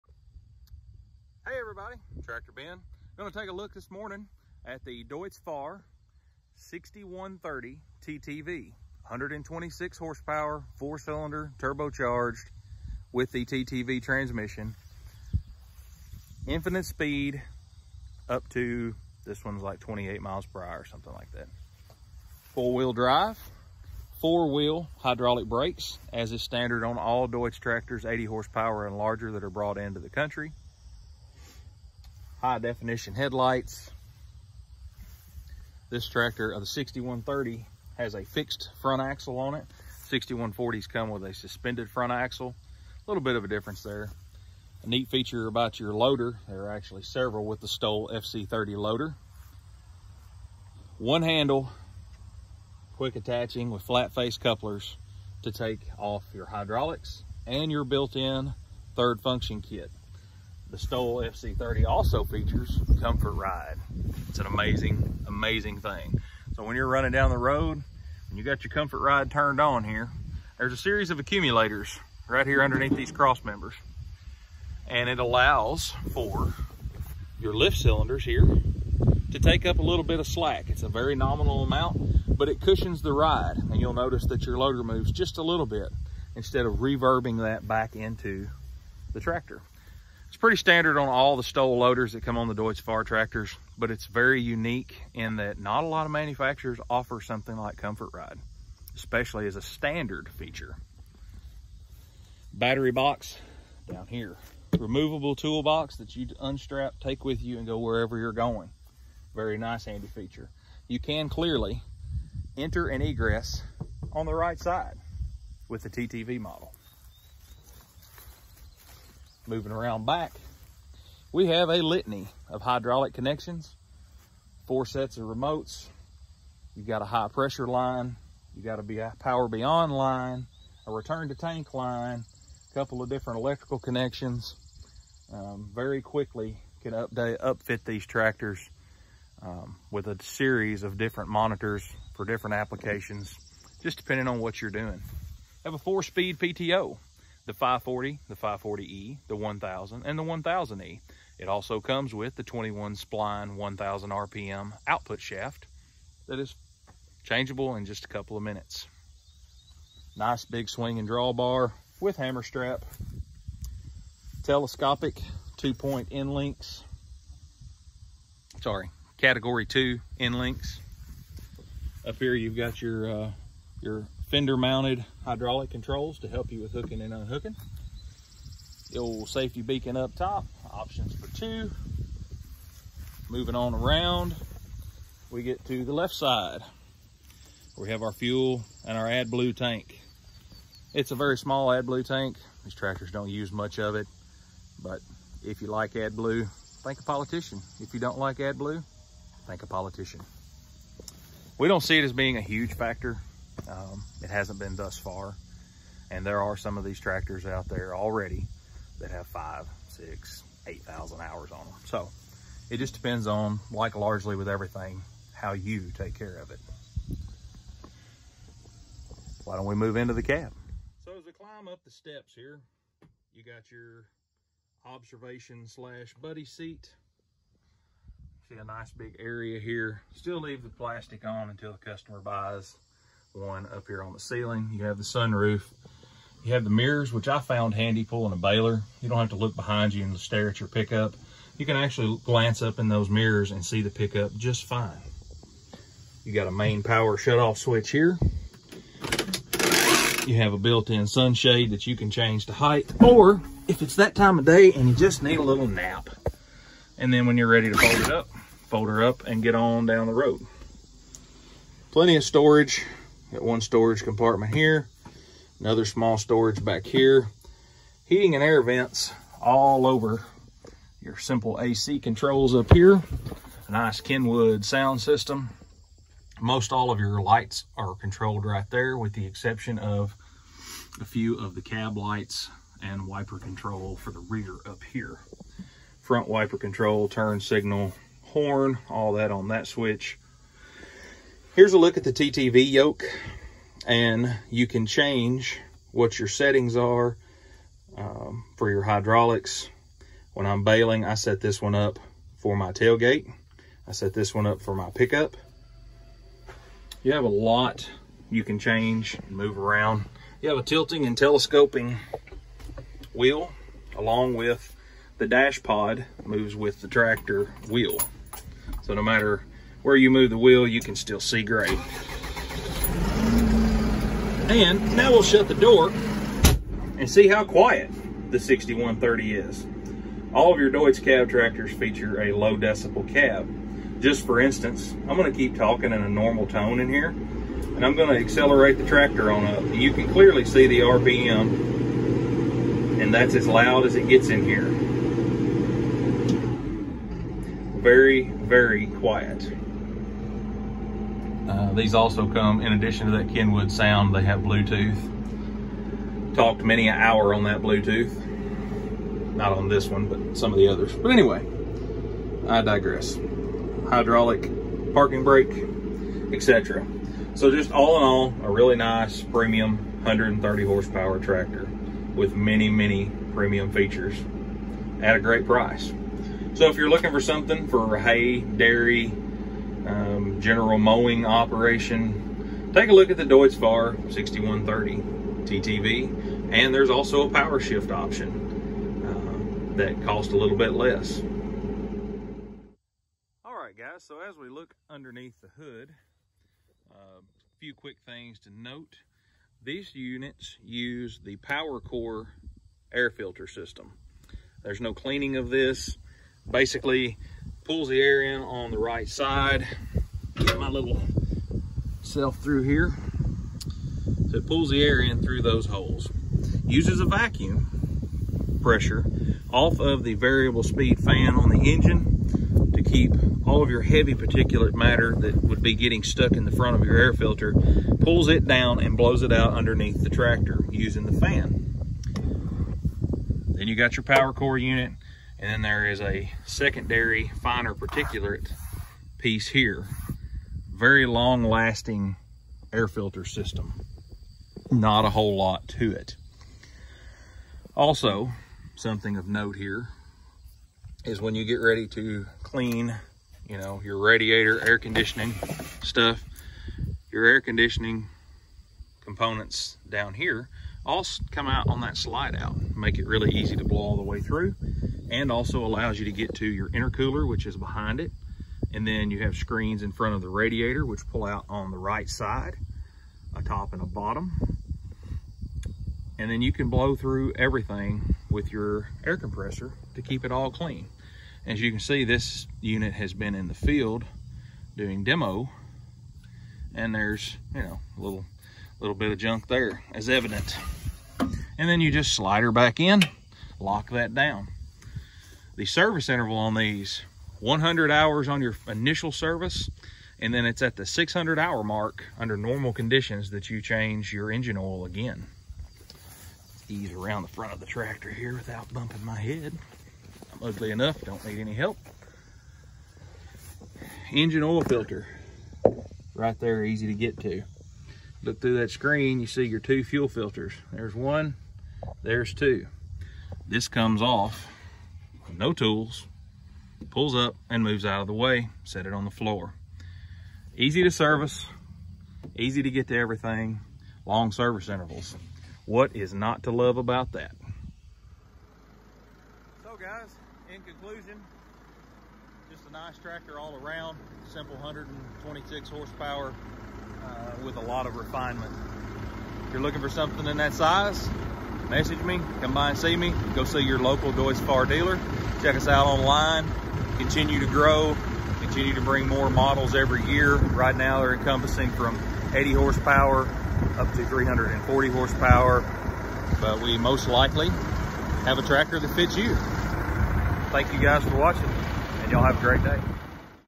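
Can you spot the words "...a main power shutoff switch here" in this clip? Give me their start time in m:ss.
4:06.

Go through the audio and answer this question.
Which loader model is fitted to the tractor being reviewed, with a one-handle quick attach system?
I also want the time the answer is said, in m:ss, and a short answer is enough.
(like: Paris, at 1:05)
Stoll FC30, at 0:47.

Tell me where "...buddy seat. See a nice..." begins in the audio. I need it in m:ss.
3:46.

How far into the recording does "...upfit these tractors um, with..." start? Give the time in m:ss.
2:17.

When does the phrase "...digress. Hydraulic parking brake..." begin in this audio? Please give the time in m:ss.
6:02.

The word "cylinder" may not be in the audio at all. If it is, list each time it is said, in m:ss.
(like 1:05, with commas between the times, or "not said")
0:10, 1:17.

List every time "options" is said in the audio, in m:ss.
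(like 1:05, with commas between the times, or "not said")
3:00, 6:27.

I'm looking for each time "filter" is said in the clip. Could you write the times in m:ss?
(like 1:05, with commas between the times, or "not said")
6:43, 7:07, 7:22, 8:34, 8:40.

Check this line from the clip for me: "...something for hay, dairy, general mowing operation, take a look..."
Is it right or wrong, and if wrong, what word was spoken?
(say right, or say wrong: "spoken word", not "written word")
right.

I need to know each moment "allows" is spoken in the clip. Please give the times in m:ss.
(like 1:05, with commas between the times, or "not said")
1:15, 7:45.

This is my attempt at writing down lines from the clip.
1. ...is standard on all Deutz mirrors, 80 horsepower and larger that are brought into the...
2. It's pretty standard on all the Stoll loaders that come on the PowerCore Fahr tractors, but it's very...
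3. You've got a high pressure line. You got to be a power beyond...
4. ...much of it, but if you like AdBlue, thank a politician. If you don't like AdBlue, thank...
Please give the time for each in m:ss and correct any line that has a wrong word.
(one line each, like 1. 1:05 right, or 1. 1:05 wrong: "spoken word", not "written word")
1. 0:26 wrong: "tractors", not "mirrors"
2. 1:30 wrong: "Deutz", not "PowerCore"
3. 2:06 right
4. 3:13 right.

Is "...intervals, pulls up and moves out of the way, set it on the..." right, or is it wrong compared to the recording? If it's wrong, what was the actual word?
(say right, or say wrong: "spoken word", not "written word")
wrong: "tools", not "intervals".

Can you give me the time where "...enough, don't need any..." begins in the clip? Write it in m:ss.
8:30.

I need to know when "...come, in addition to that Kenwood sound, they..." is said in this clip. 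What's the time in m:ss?
5:52.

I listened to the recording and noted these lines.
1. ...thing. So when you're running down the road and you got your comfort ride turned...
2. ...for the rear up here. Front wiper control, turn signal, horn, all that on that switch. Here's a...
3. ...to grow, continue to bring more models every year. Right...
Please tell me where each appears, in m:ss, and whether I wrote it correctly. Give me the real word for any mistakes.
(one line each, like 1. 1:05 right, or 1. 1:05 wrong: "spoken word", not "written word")
1. 1:05 right
2. 4:43 right
3. 9:17 right.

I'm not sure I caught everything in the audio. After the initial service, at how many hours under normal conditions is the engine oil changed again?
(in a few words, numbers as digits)
600.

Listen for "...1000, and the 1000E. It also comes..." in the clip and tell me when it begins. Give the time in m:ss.
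2:29.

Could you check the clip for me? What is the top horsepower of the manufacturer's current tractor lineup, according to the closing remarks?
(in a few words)
340.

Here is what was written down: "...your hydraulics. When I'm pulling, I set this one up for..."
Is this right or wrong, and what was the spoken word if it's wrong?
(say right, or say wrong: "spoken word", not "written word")
wrong: "baling", not "pulling".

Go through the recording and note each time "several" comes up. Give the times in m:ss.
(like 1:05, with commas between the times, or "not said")
0:47.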